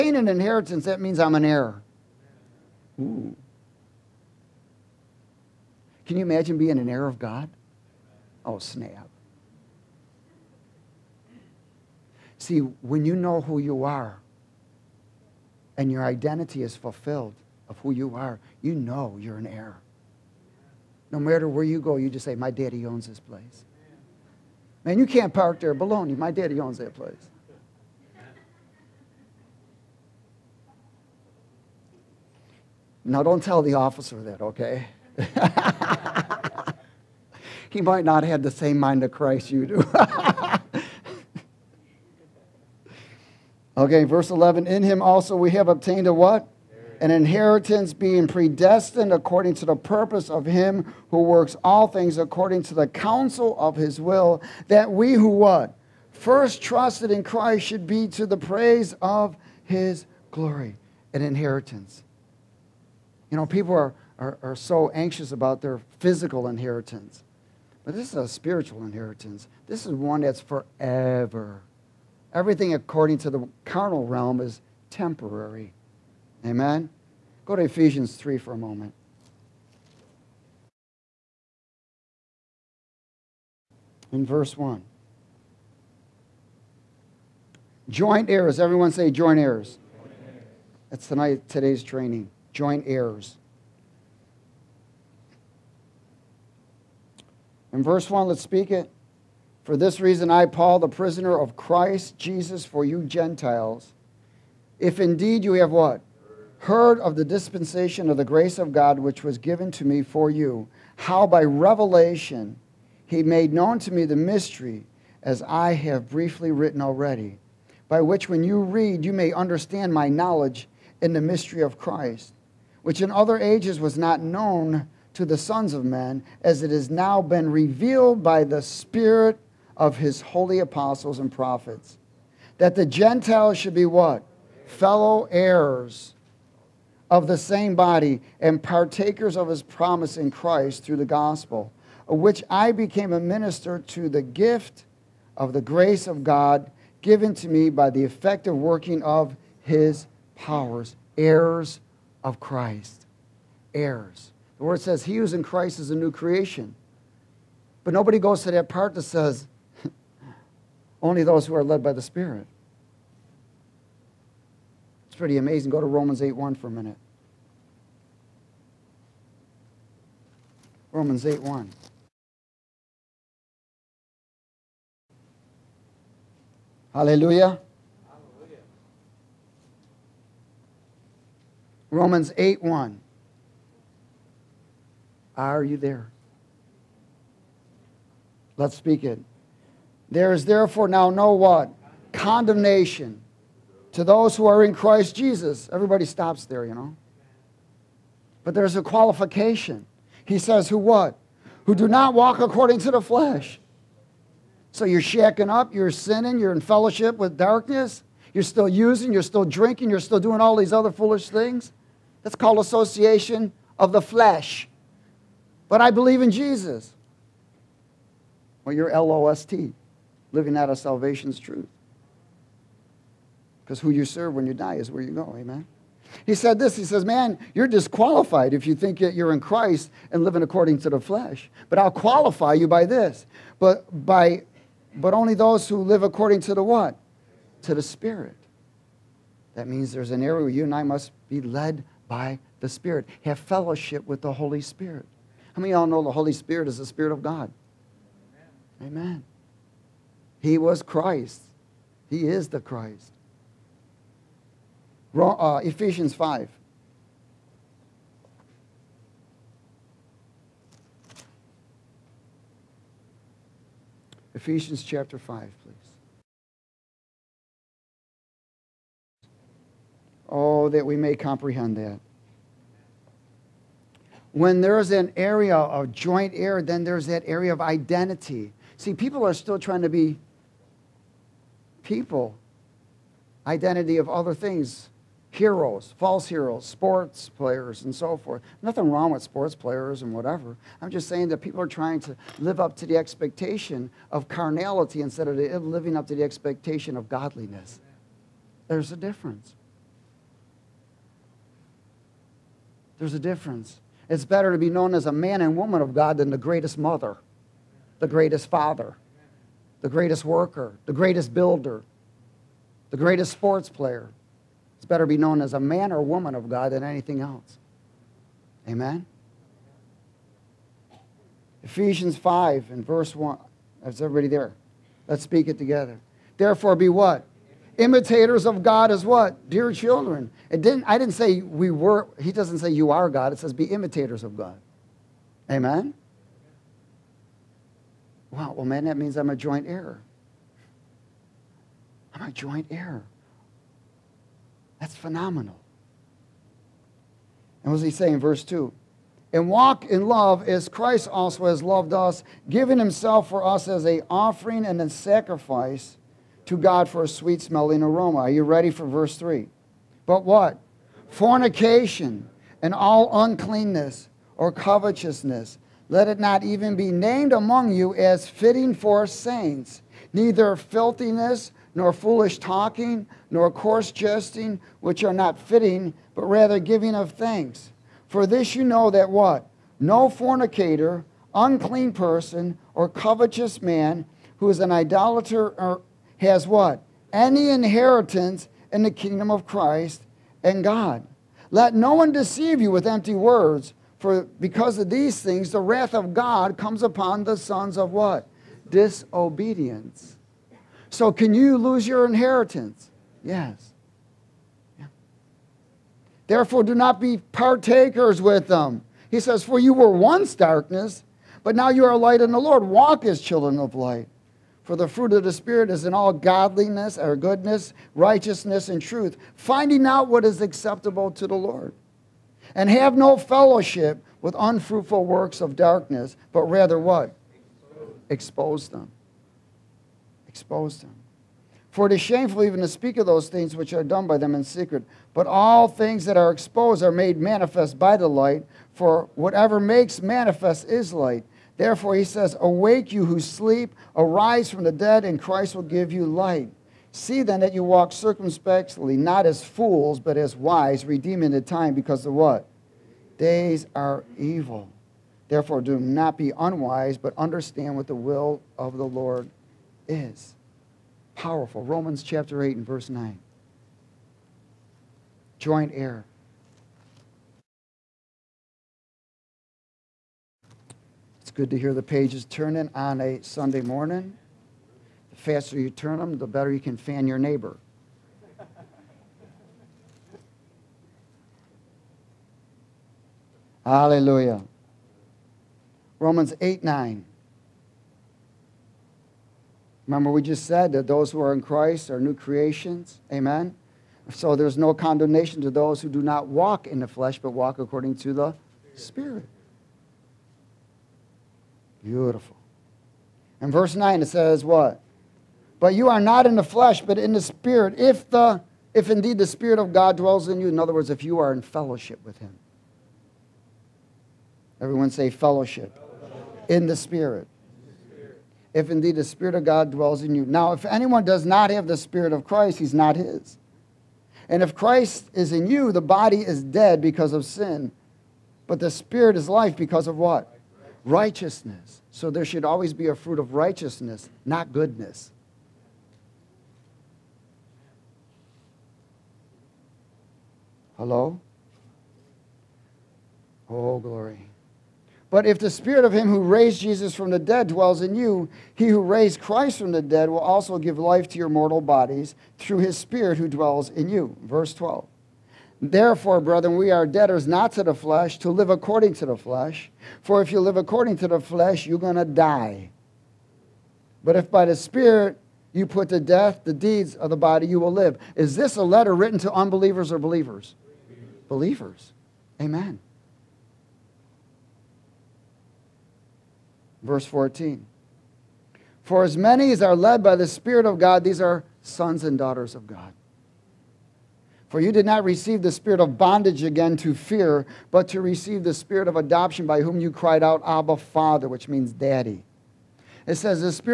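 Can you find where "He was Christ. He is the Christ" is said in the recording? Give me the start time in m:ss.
4:10.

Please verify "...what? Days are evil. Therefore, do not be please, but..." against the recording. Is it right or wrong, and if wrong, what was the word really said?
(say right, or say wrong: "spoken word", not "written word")
wrong: "unwise", not "please".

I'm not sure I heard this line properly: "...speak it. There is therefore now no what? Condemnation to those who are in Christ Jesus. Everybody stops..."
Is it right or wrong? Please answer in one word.
right.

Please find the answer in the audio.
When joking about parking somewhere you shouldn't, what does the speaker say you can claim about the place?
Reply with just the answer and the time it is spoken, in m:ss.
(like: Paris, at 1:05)
My daddy owns this place, at 0:22.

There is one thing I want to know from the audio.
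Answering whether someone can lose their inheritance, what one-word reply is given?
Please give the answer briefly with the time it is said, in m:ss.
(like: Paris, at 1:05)
Yes, at 6:43.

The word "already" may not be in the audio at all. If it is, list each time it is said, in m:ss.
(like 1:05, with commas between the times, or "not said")
1:56.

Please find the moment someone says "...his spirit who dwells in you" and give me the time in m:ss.
9:12.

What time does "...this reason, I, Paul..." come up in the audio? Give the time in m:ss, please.
1:39.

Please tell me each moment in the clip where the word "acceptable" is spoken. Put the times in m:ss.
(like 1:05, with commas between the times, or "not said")
7:00.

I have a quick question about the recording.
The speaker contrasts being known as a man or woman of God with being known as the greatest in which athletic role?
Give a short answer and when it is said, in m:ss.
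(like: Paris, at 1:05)
Sports player, at 5:12.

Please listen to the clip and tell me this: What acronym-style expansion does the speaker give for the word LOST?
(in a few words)
Living out of salvation's truth.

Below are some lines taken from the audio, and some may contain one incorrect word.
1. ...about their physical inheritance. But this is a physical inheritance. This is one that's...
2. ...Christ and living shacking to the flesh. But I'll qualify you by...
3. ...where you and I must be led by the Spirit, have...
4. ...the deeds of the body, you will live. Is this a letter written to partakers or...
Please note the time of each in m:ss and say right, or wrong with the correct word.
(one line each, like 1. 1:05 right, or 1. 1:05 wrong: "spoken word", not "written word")
1. 1:05 wrong: "spiritual", not "physical"
2. 3:49 wrong: "according", not "shacking"
3. 4:00 right
4. 9:26 wrong: "unbelievers", not "partakers".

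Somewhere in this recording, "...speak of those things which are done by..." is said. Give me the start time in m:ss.
7:12.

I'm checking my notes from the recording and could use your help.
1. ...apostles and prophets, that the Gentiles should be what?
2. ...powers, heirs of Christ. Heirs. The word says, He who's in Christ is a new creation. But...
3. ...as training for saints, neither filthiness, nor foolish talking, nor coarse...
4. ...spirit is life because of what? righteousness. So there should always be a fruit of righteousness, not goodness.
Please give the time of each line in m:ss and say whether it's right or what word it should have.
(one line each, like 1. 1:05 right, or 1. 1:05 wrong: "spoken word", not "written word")
1. 2:10 right
2. 2:30 right
3. 6:07 wrong: "fitting", not "training"
4. 8:48 right.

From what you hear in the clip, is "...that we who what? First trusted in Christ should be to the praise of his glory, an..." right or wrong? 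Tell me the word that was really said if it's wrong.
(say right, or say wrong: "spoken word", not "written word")
right.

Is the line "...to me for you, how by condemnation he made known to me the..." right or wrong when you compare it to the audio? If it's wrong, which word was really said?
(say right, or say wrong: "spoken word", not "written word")
wrong: "revelation", not "condemnation".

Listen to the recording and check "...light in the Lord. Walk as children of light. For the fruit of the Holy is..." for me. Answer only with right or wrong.
wrong.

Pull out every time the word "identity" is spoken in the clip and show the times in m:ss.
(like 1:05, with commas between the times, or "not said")
0:16, 4:37, 4:43.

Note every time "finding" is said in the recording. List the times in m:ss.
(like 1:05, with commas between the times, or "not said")
6:59.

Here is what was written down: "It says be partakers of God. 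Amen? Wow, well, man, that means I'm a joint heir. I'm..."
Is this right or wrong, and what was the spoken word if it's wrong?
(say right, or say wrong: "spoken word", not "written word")
wrong: "imitators", not "partakers".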